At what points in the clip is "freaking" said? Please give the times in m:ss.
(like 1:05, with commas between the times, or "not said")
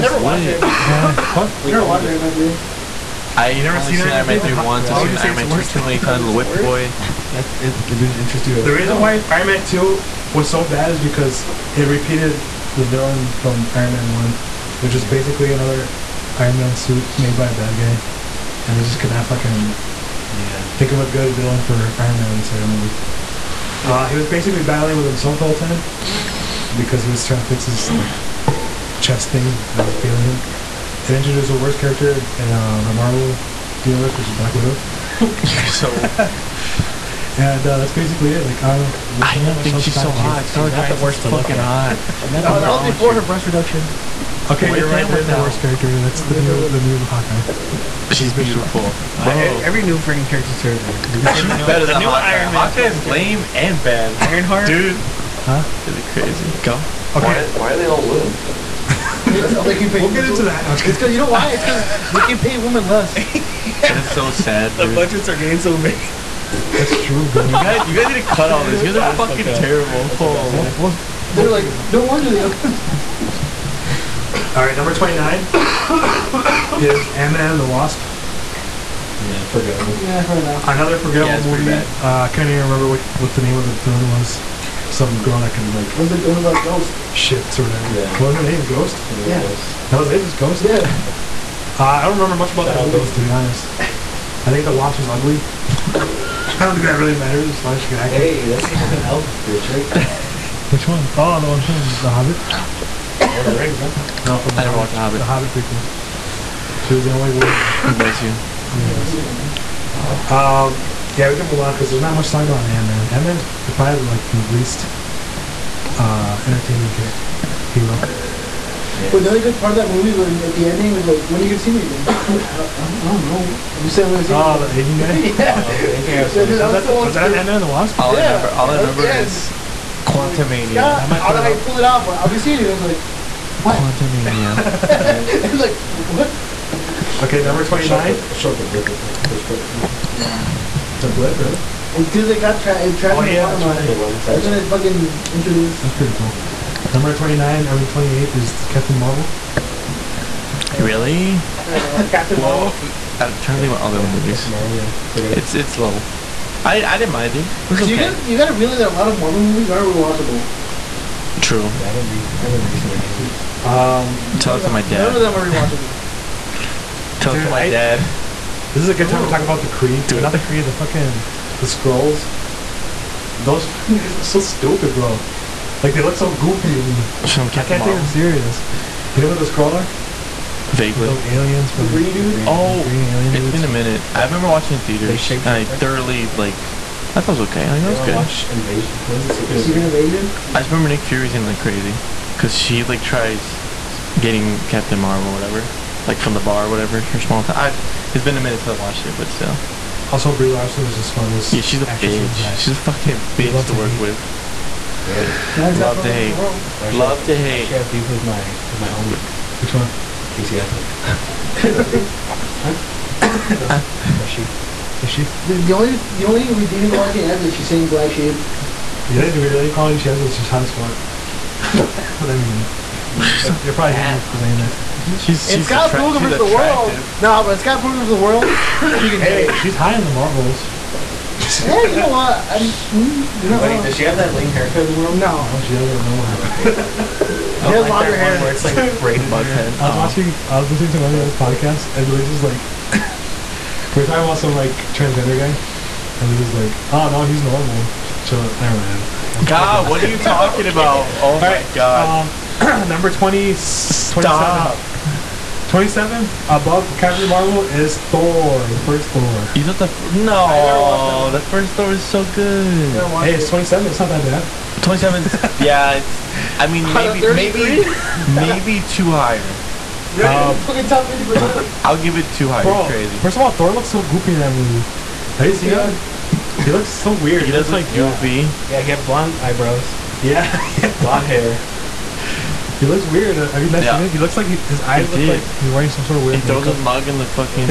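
0:49.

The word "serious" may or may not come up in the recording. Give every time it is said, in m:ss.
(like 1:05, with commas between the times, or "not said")
2:58.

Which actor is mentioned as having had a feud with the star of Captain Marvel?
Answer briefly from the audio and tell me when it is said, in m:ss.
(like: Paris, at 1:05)
Casey Affleck, at 3:30.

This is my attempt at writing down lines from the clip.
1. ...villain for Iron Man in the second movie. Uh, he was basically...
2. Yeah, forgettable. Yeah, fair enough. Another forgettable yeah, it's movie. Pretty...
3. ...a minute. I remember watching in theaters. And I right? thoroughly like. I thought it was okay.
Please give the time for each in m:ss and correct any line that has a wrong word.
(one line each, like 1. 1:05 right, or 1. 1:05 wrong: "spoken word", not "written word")
1. 0:21 right
2. 1:19 right
3. 3:03 right.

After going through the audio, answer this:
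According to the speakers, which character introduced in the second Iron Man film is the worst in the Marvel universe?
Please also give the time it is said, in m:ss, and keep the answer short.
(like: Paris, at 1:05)
Black Widow, at 0:34.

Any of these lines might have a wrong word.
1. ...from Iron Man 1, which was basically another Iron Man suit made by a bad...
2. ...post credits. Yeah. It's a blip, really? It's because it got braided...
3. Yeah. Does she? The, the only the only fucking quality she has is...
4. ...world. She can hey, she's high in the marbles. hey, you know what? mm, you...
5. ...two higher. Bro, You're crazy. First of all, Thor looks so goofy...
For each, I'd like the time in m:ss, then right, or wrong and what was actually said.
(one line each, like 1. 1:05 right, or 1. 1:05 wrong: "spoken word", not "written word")
1. 0:13 right
2. 2:19 wrong: "trapped", not "braided"
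3. 3:34 wrong: "redeeming", not "fucking"
4. 3:48 right
5. 4:32 right.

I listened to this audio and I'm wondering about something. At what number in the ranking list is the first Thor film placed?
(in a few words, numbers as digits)
27.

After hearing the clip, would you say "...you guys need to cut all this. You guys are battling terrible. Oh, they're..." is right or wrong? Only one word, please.
wrong.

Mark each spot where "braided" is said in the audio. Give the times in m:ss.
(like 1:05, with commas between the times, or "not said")
3:58.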